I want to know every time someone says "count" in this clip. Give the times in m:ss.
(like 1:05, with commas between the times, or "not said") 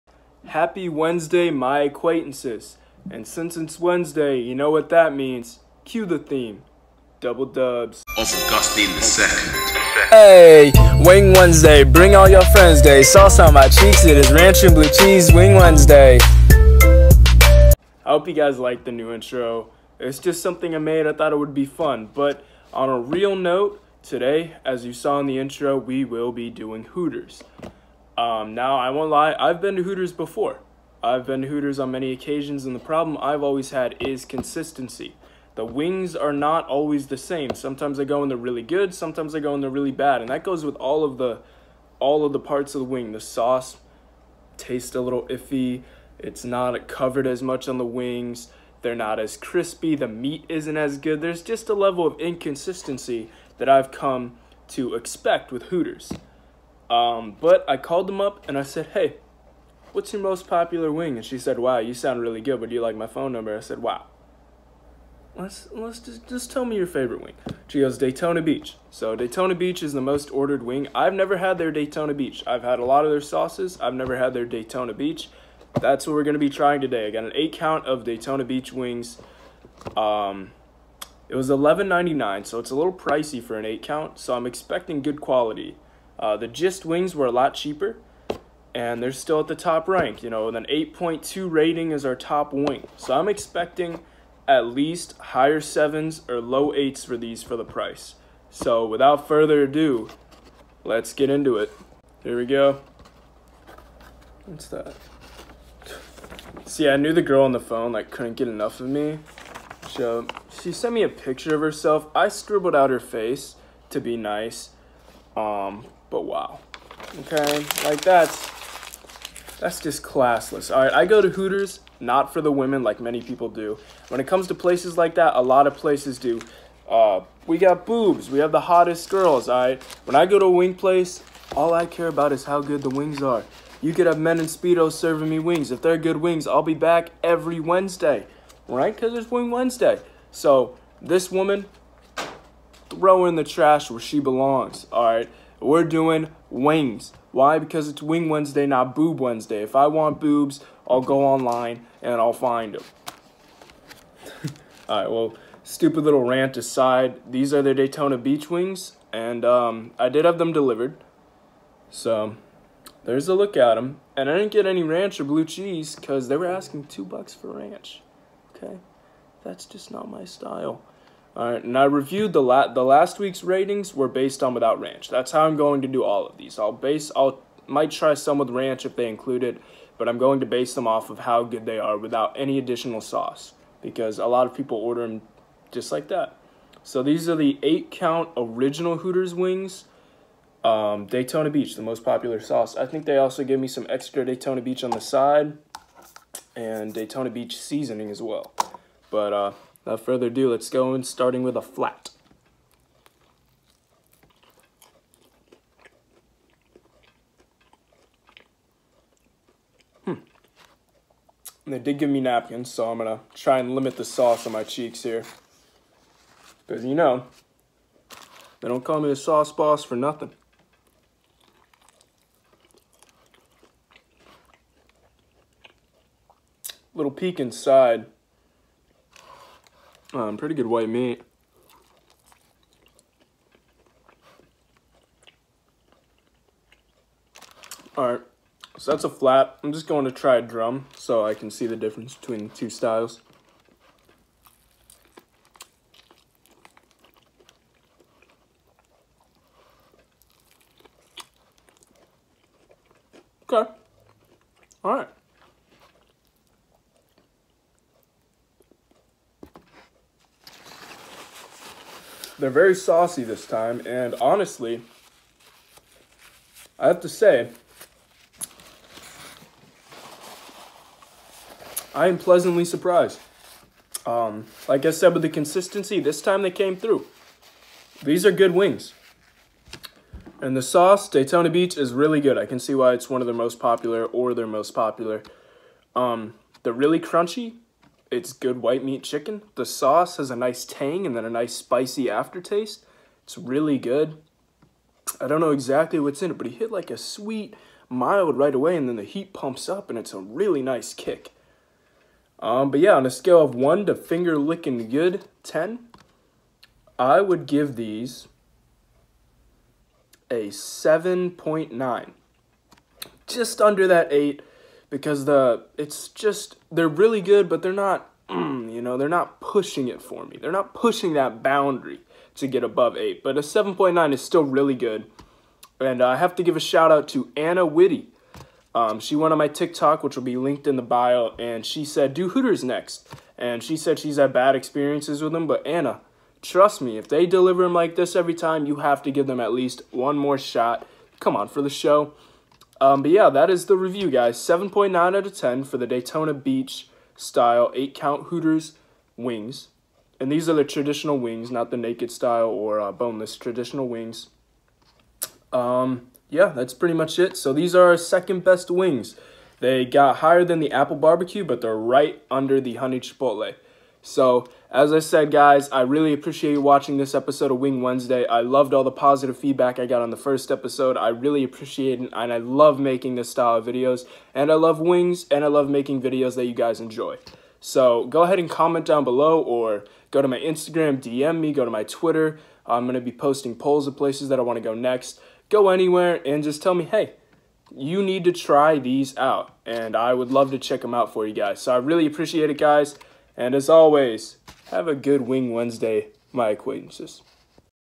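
1:17, 1:23, 3:07, 5:47.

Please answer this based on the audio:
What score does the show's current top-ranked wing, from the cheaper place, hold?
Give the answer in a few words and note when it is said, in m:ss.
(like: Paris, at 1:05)
8.2, at 1:30.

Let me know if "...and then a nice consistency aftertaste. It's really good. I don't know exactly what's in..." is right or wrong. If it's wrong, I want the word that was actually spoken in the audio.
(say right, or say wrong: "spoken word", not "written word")
wrong: "spicy", not "consistency".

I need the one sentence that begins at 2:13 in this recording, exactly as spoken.
You could have men in Speedos serving me wings.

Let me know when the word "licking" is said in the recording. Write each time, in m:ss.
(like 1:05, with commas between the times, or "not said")
5:04.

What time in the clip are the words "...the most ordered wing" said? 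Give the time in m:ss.
1:09.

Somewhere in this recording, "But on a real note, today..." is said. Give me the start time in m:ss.
0:22.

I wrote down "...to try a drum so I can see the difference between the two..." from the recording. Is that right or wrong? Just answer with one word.
right.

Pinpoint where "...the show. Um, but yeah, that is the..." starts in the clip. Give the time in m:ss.
5:41.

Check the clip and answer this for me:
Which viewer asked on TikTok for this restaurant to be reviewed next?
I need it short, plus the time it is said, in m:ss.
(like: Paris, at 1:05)
Anna Witty, at 5:27.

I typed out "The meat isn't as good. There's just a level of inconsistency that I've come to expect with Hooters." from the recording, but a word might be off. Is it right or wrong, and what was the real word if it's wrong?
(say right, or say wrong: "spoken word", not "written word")
right.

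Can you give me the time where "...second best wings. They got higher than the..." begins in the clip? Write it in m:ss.
5:57.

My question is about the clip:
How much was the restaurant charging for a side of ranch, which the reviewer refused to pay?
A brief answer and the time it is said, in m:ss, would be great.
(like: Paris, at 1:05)
2 bucks, at 2:46.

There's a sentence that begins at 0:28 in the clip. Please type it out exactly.
Um, now, I won't lie, I've been to Hooters before.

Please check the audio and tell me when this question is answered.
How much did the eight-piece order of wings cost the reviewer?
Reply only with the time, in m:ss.
1:21.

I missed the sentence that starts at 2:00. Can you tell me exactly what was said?
All right, I go to Hooters, not for the women like many people do.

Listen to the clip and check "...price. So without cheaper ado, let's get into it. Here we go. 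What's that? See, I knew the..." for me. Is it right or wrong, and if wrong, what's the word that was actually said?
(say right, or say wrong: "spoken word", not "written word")
wrong: "further", not "cheaper".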